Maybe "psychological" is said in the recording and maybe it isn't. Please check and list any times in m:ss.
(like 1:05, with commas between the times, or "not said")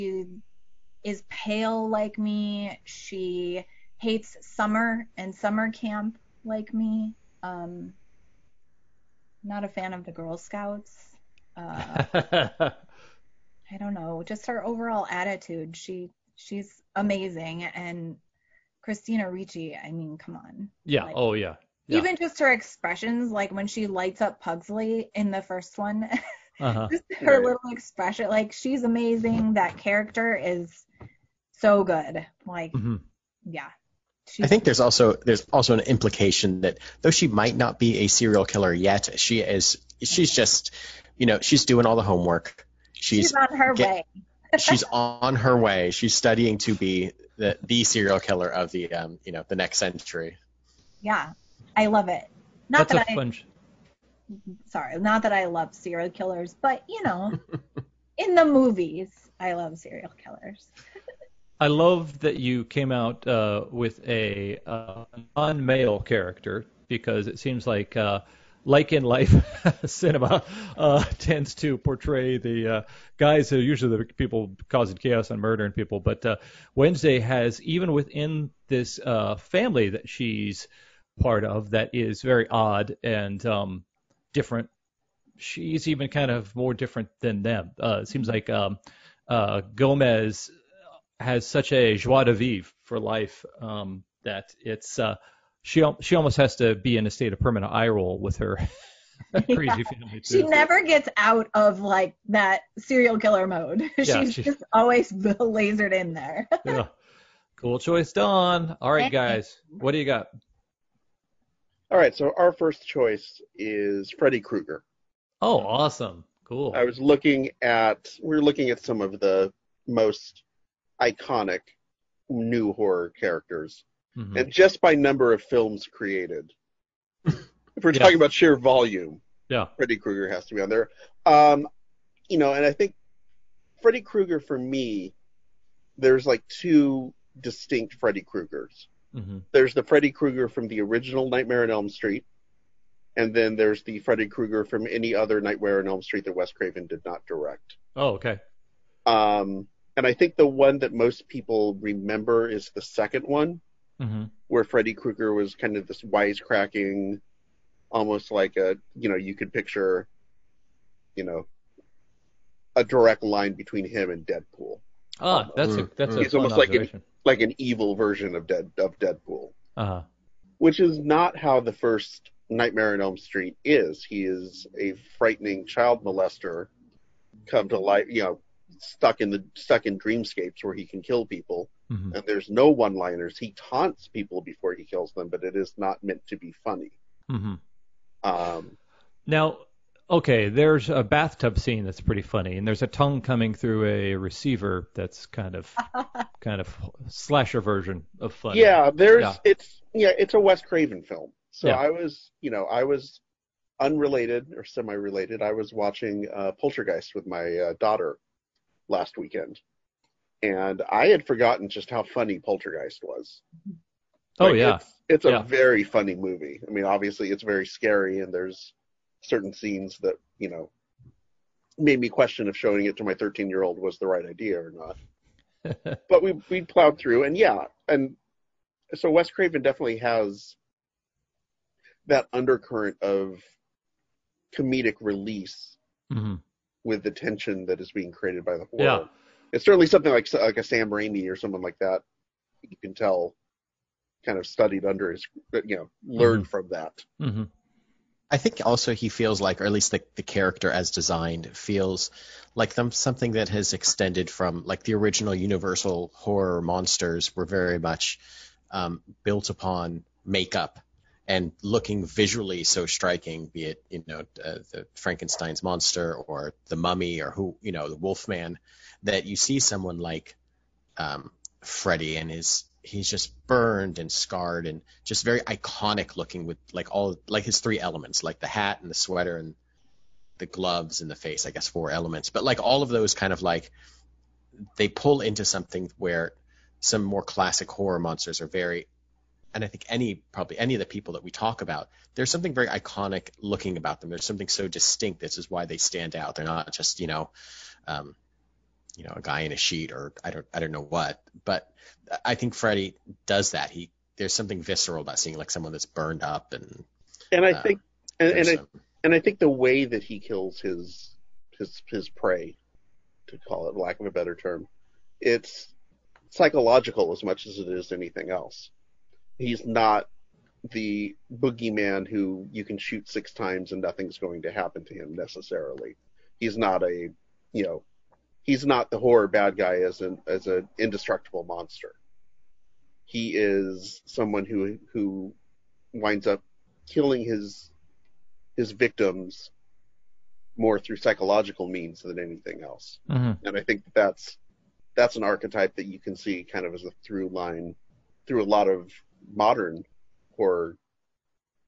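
5:16, 5:40.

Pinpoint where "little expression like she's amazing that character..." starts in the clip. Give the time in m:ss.
0:27.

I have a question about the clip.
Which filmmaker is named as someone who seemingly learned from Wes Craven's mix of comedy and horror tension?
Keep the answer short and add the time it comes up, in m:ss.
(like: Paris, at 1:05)
Sam Raimi, at 4:00.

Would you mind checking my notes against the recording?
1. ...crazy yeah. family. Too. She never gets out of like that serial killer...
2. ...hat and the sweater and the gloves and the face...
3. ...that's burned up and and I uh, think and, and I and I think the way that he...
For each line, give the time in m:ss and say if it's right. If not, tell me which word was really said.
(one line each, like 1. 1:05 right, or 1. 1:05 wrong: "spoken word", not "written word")
1. 1:39 right
2. 4:38 right
3. 5:05 right.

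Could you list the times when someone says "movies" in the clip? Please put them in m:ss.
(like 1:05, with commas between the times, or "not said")
0:58, 3:36.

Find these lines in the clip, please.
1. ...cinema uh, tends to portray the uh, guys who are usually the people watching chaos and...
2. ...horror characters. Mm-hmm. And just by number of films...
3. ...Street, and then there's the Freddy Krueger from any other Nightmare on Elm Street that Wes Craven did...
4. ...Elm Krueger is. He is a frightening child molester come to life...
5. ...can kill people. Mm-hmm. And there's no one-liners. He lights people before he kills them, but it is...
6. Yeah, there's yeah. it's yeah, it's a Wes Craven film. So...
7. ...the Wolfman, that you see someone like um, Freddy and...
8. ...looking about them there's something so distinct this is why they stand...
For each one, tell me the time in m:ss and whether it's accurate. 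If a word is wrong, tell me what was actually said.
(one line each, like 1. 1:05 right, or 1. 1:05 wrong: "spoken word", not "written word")
1. 1:09 wrong: "causing", not "watching"
2. 2:02 right
3. 2:21 right
4. 2:53 wrong: "Street", not "Krueger"
5. 3:00 wrong: "taunts", not "lights"
6. 3:18 right
7. 4:27 right
8. 4:53 right.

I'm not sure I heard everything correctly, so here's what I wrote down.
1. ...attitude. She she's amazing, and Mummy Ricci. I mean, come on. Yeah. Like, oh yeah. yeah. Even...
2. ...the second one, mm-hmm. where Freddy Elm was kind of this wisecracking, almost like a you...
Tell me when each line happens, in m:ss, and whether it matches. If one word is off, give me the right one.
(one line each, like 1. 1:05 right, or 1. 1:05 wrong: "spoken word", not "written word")
1. 0:15 wrong: "Christina", not "Mummy"
2. 2:32 wrong: "Krueger", not "Elm".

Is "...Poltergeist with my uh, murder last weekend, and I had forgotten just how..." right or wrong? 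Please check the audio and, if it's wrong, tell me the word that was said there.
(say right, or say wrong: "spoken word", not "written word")
wrong: "daughter", not "murder".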